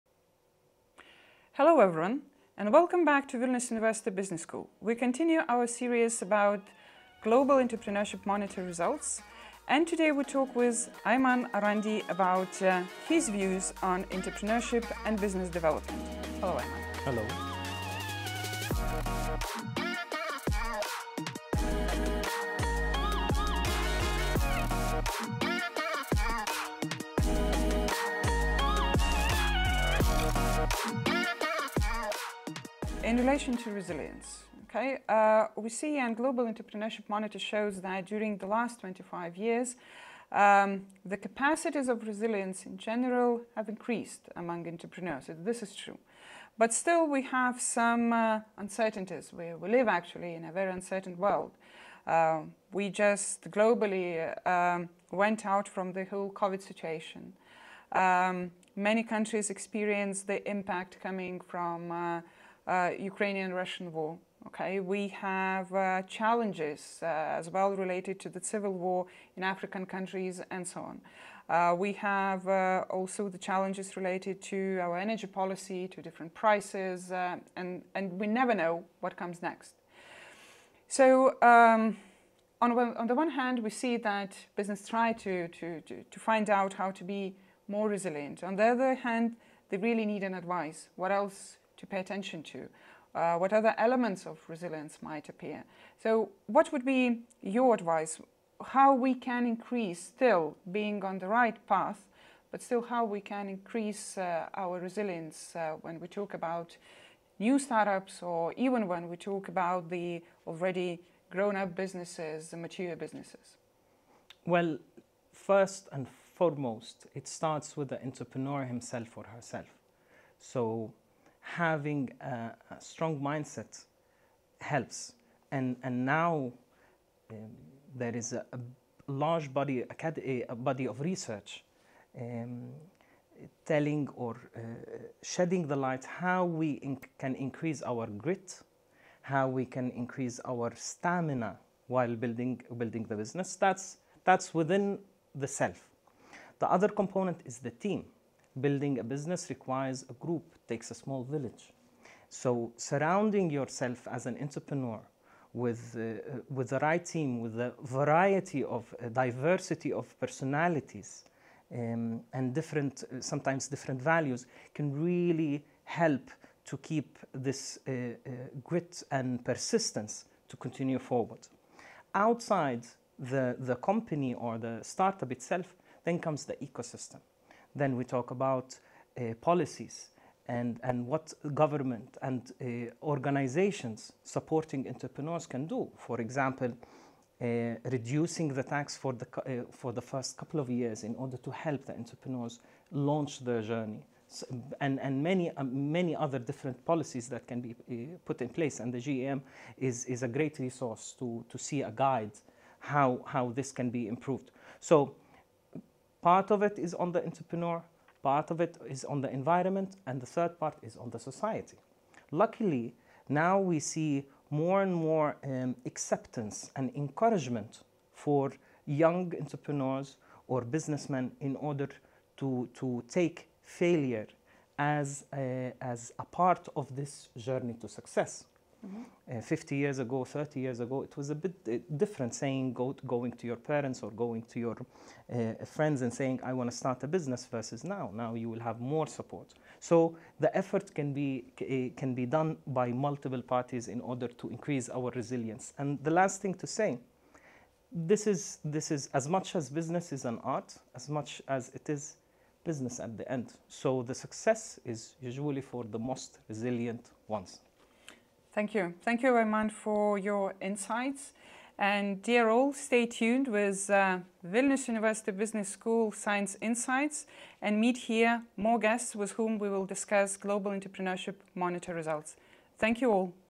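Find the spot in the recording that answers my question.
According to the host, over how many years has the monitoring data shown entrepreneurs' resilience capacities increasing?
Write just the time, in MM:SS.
00:38.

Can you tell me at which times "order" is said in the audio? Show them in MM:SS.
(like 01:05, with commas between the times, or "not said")
03:11, 03:41, 04:04.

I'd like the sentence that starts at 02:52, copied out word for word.
Outside the, the company or the startup itself, then comes the ecosystem.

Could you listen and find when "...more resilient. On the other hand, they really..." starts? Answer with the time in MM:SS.
01:27.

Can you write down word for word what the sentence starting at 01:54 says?
Well, first and foremost, it starts with the entrepreneur himself or herself.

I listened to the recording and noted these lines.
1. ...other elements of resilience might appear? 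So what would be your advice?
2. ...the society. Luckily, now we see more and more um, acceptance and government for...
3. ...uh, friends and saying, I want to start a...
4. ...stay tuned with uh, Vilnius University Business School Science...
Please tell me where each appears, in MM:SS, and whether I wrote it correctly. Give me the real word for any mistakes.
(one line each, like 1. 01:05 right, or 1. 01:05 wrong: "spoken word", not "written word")
1. 01:33 right
2. 03:31 wrong: "encouragement", not "government"
3. 03:55 right
4. 04:22 right.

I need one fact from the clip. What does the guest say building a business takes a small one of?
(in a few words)
a small village.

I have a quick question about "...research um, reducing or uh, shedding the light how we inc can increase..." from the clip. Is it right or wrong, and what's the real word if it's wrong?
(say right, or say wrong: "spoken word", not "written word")
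wrong: "telling", not "reducing".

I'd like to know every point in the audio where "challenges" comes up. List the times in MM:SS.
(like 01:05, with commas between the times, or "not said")
01:06, 01:13.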